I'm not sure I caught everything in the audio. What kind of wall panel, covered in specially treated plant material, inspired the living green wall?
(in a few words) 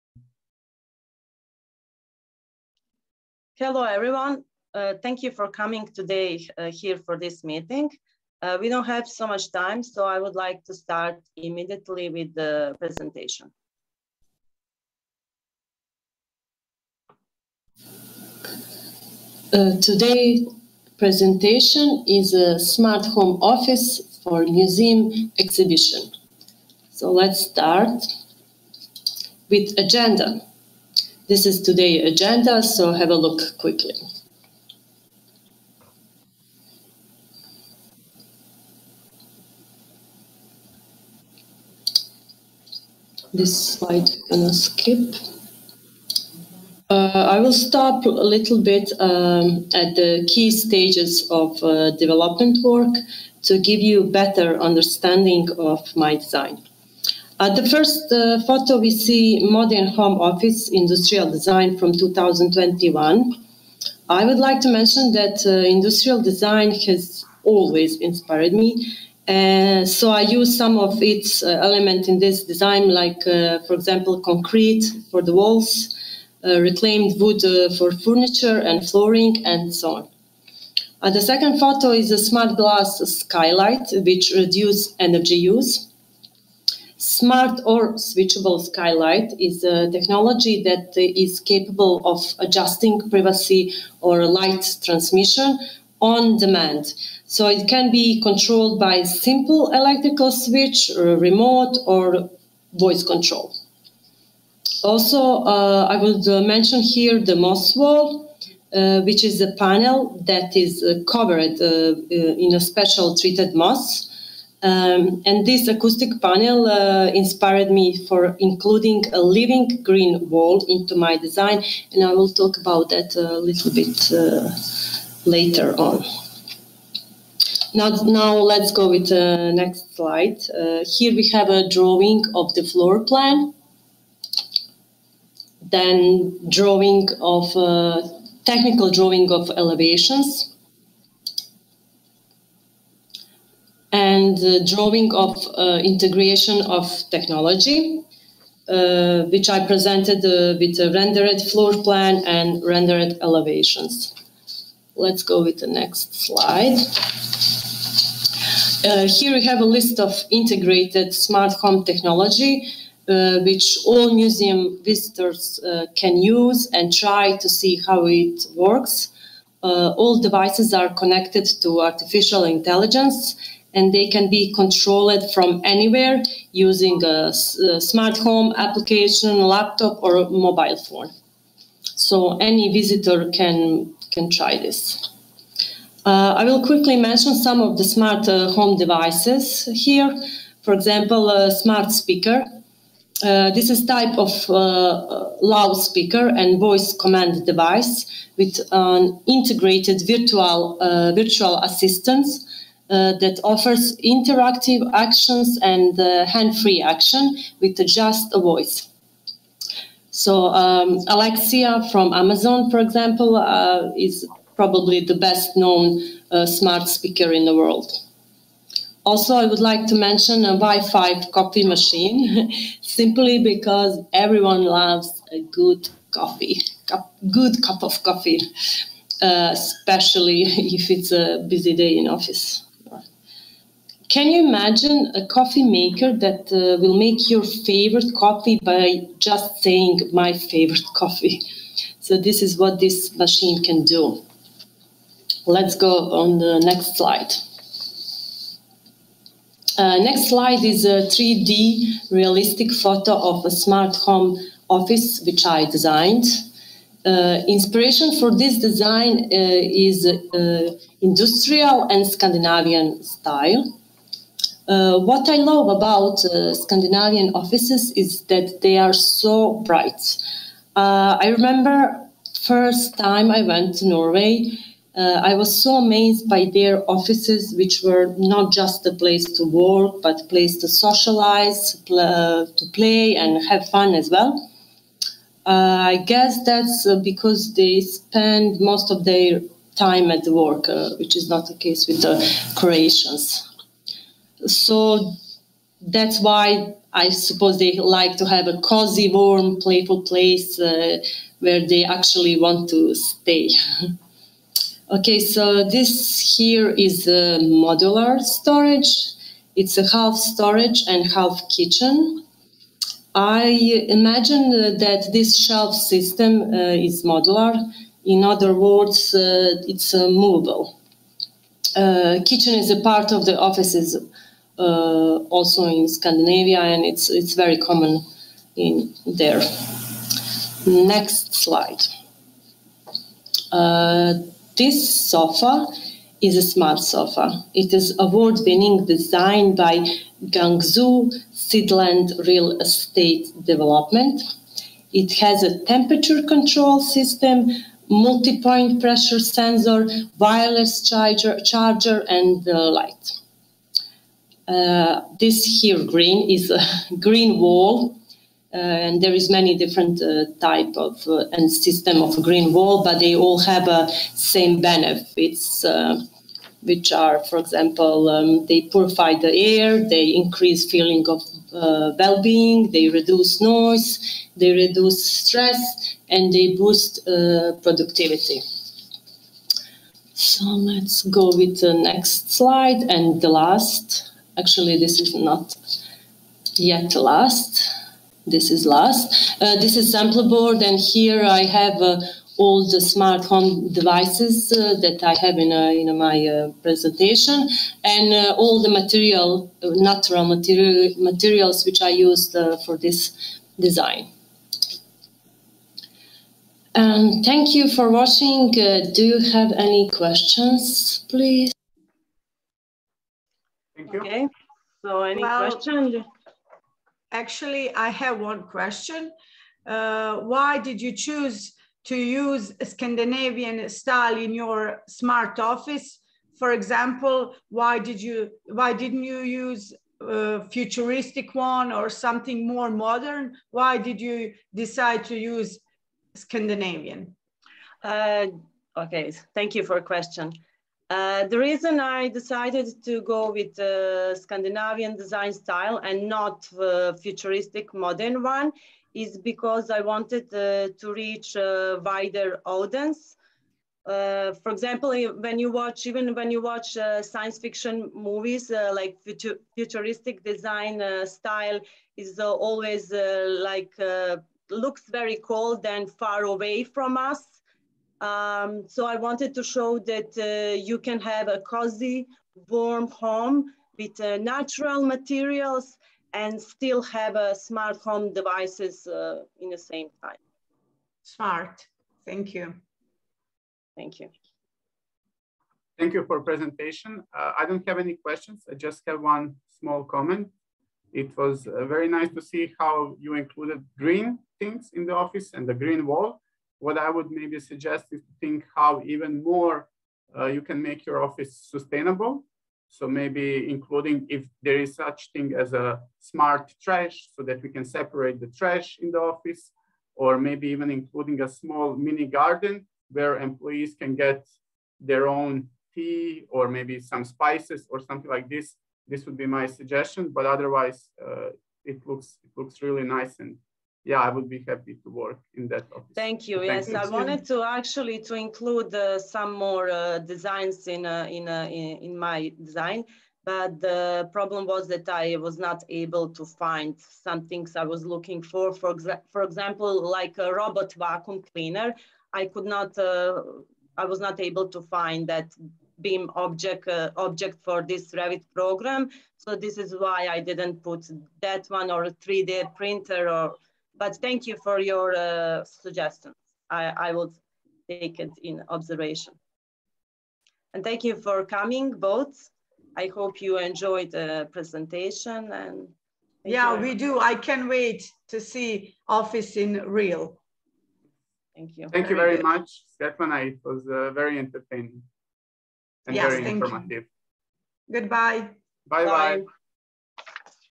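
Moss wall.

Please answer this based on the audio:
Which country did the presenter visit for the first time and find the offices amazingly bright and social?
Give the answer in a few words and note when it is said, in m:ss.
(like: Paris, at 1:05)
Norway, at 4:33.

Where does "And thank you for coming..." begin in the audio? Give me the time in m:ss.
9:20.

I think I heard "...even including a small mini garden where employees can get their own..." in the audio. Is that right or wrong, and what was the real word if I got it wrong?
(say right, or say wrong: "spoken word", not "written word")
right.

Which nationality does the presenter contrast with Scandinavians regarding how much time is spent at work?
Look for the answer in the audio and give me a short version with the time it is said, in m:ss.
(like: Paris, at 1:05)
Croatians, at 4:52.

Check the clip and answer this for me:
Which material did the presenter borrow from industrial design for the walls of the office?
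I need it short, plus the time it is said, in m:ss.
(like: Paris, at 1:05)
Concrete, at 1:14.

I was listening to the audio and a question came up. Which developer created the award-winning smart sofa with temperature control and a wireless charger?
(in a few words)
Guangzhou Sidland Real Estate Development.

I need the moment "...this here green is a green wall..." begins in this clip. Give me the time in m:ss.
5:55.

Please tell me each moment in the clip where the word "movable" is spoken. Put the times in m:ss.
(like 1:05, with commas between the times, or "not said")
5:20.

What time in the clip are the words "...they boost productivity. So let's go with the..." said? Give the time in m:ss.
6:16.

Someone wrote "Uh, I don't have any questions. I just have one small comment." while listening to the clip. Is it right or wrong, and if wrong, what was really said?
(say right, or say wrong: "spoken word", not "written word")
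right.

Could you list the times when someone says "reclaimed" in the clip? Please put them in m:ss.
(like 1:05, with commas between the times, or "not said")
1:16.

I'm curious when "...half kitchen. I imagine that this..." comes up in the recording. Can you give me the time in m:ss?
5:11.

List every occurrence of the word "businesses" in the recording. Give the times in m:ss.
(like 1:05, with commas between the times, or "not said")
not said.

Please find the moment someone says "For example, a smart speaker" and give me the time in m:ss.
3:10.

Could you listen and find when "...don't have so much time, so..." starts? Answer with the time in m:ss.
0:08.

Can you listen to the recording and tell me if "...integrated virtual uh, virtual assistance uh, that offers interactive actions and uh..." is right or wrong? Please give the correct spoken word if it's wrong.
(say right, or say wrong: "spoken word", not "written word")
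right.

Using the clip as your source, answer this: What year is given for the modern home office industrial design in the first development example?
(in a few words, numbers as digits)
2021.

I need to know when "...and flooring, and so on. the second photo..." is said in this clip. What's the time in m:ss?
1:18.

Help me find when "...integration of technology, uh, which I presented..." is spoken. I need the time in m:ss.
2:25.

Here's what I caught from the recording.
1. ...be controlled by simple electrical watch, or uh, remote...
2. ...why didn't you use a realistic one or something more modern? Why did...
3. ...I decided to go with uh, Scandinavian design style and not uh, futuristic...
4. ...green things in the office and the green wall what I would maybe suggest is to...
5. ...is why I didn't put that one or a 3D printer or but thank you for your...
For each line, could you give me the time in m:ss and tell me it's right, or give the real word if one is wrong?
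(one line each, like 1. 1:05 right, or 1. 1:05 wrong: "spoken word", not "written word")
1. 1:37 wrong: "switch", not "watch"
2. 7:08 wrong: "futuristic", not "realistic"
3. 7:21 right
4. 8:13 right
5. 9:09 right.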